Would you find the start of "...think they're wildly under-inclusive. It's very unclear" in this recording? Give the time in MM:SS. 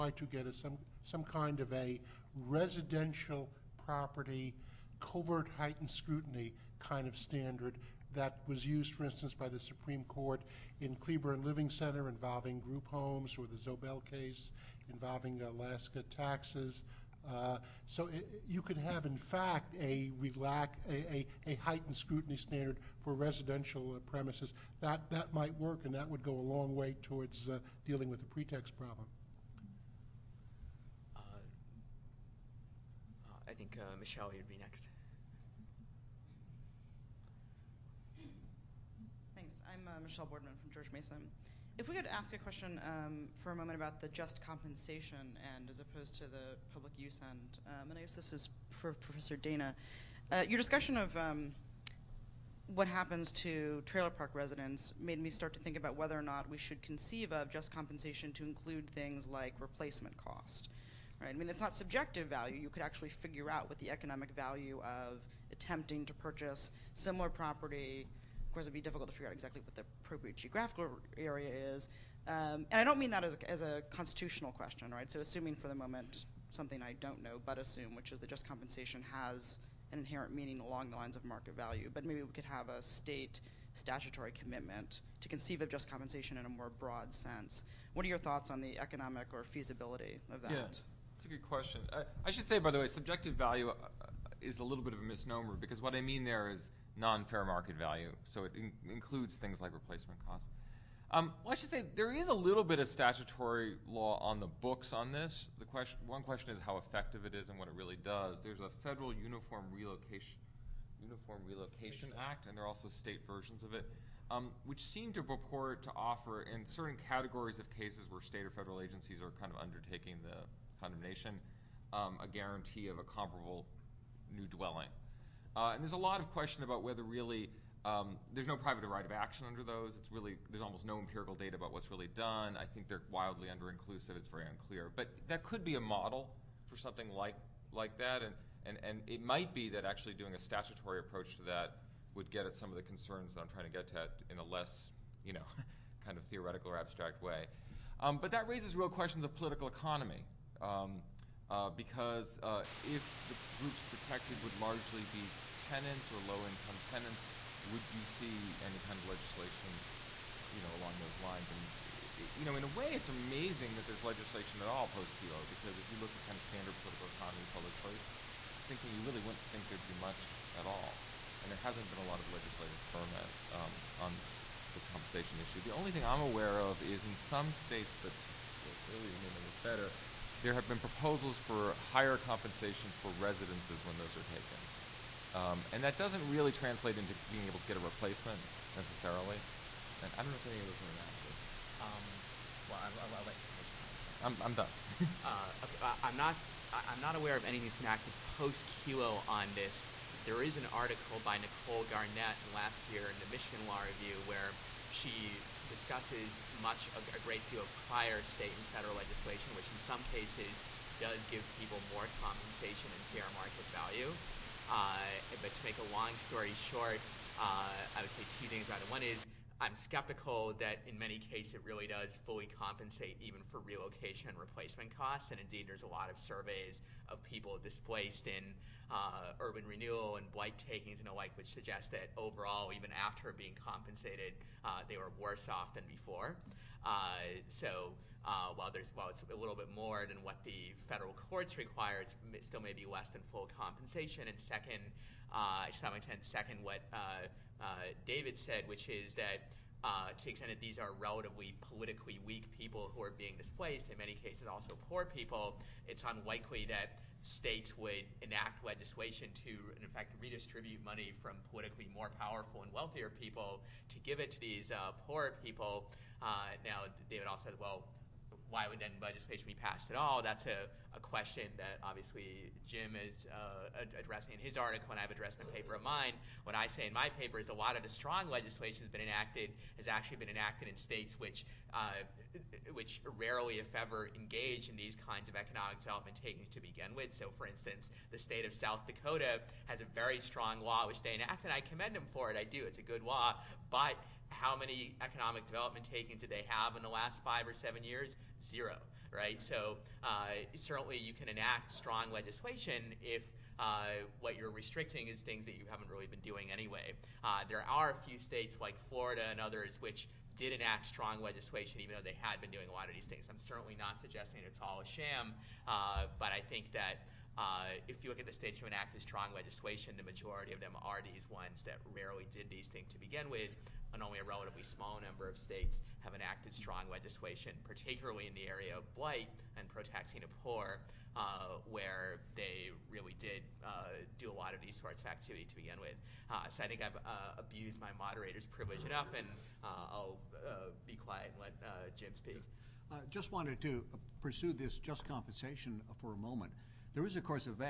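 02:12.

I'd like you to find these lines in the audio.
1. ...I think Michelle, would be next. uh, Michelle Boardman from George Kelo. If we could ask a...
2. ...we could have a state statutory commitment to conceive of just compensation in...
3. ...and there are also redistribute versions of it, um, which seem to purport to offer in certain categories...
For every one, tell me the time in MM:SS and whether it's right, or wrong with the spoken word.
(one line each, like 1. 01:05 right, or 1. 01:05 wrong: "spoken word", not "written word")
1. 00:33 wrong: "Mason", not "Kelo"
2. 01:22 right
3. 01:52 wrong: "state", not "redistribute".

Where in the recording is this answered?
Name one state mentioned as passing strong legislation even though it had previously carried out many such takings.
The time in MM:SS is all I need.
05:08.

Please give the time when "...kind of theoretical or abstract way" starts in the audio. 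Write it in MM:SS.
02:26.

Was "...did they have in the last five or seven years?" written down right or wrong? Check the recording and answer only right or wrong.
right.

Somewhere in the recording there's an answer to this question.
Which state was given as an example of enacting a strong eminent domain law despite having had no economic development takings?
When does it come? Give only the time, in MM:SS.
04:48.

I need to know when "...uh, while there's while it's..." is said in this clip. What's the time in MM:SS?
03:58.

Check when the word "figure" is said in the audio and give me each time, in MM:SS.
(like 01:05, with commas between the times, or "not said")
01:03, 01:09.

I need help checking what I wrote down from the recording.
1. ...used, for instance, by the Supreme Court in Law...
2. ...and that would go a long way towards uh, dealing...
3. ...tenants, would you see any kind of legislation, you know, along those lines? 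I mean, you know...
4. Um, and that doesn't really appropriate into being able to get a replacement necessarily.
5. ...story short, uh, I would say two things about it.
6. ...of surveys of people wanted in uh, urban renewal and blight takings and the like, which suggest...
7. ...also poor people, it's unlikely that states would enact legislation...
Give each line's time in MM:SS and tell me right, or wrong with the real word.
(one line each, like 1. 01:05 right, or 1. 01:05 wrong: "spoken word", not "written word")
1. 00:08 wrong: "Cleburne", not "Law"
2. 00:25 right
3. 02:36 right
4. 03:05 wrong: "translate", not "appropriate"
5. 03:36 right
6. 03:46 wrong: "displaced", not "wanted"
7. 04:14 right.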